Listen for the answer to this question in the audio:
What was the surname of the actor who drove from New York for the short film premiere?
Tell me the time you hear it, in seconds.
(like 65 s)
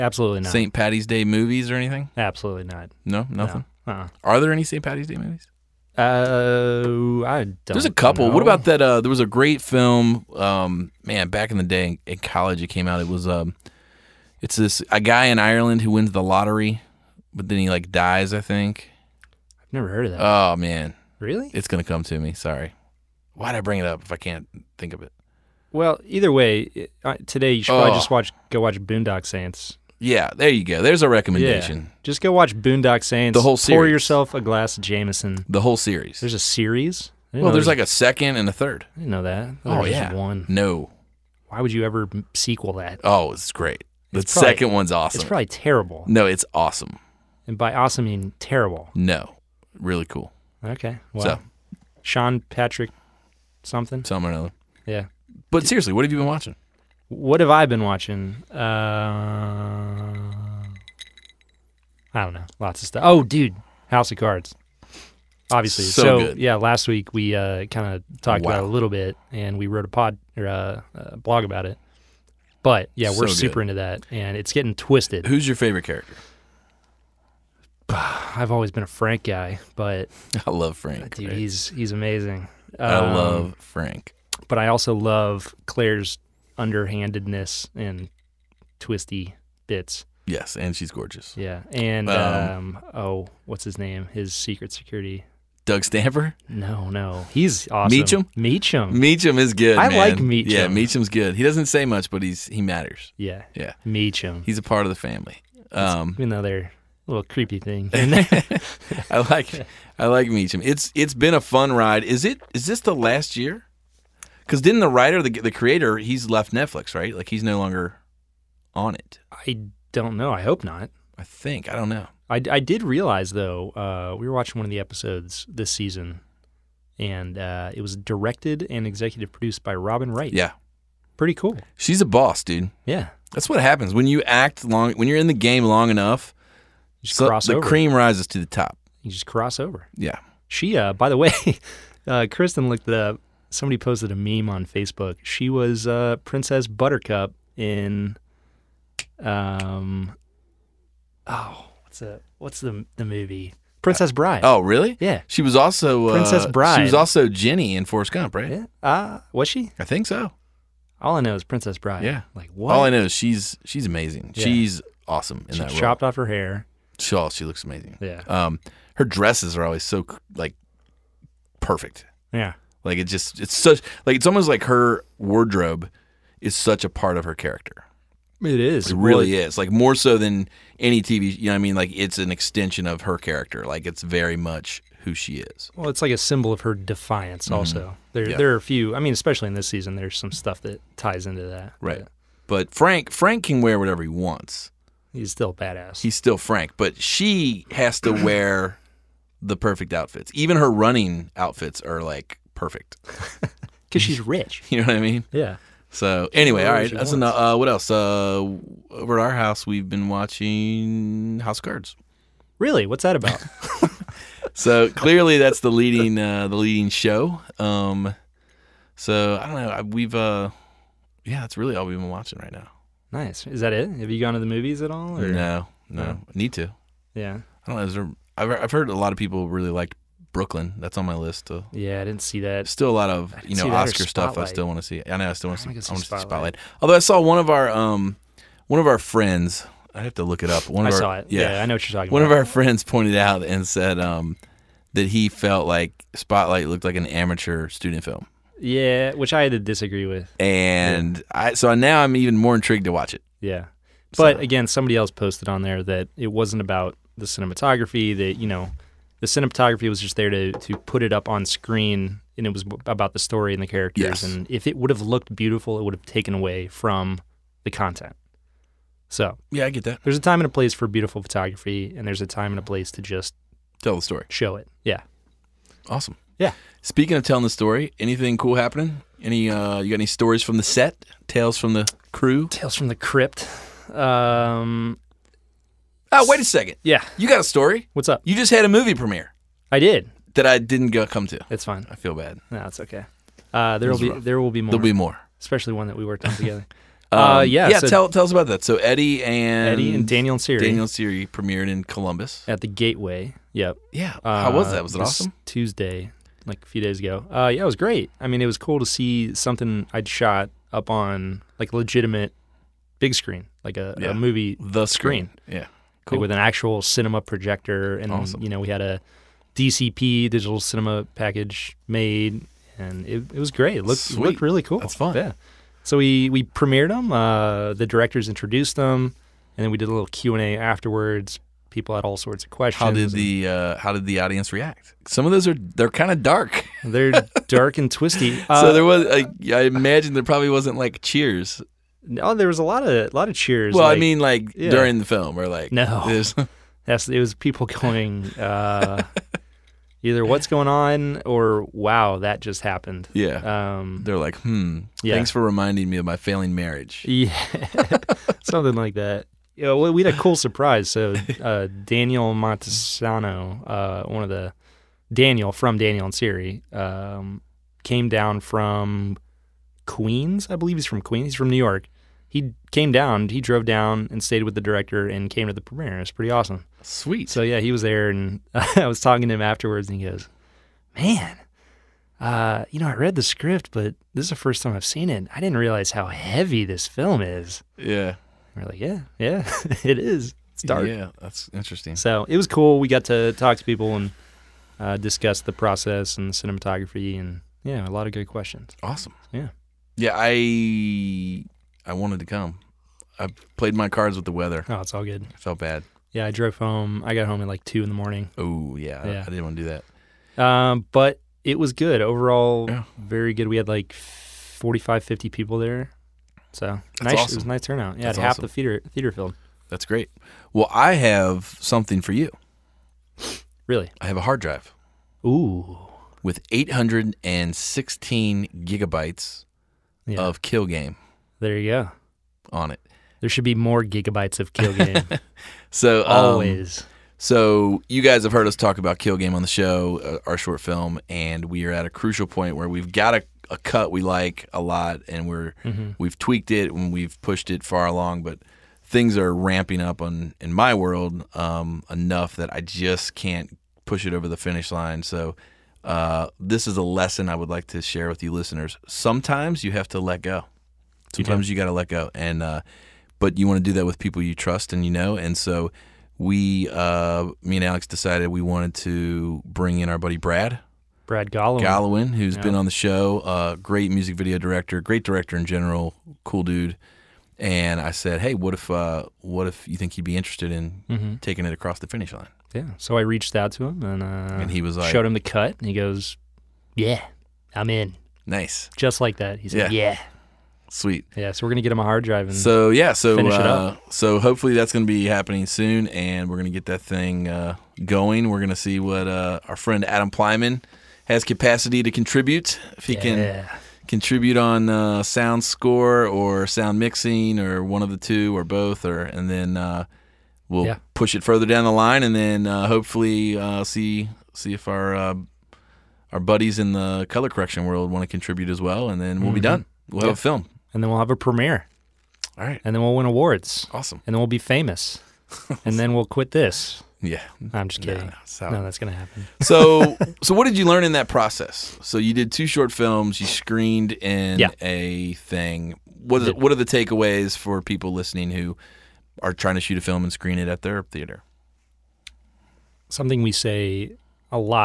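362 s.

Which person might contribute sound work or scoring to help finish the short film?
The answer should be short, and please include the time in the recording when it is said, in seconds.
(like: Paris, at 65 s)
Adam Plyman, at 499 s.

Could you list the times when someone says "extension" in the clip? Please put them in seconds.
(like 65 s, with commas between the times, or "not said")
182 s.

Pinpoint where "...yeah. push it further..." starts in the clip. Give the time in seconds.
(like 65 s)
510 s.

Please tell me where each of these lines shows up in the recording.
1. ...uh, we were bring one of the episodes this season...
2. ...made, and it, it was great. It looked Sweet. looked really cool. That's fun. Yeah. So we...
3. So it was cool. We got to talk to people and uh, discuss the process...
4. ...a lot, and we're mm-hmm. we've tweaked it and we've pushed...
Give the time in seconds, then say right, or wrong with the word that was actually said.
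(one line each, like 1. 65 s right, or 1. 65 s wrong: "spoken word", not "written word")
1. 123 s wrong: "watching", not "bring"
2. 321 s right
3. 391 s right
4. 444 s right.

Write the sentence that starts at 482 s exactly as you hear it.
So I reached out to him and uh, and he was like, showed him the cut, and he goes, yeah, I'm in.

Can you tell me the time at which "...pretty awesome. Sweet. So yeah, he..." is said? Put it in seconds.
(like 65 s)
376 s.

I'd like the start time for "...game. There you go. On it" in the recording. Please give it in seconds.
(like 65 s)
430 s.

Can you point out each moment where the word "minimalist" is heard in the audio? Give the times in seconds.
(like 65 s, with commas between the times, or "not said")
not said.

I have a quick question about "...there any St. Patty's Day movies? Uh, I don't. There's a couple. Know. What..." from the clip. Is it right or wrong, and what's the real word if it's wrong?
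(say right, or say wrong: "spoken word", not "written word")
right.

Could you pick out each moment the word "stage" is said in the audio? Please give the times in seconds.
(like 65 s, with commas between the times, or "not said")
not said.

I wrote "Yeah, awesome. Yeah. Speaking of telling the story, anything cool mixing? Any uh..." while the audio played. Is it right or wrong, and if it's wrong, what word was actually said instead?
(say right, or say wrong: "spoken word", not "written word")
wrong: "happening", not "mixing".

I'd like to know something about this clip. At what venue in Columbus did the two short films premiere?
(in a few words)
the Gateway.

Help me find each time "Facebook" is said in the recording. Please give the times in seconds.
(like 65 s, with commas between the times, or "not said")
144 s.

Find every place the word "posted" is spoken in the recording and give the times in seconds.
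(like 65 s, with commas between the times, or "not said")
143 s, 255 s.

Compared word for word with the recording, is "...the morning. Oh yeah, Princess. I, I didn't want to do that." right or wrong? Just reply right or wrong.
wrong.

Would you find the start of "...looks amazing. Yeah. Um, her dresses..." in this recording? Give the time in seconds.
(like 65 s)
167 s.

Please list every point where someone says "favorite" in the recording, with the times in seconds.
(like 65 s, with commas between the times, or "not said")
75 s.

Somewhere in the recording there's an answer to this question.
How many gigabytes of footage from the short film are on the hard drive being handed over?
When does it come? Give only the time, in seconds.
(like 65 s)
426 s.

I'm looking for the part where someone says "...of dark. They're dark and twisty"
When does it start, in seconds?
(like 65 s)
336 s.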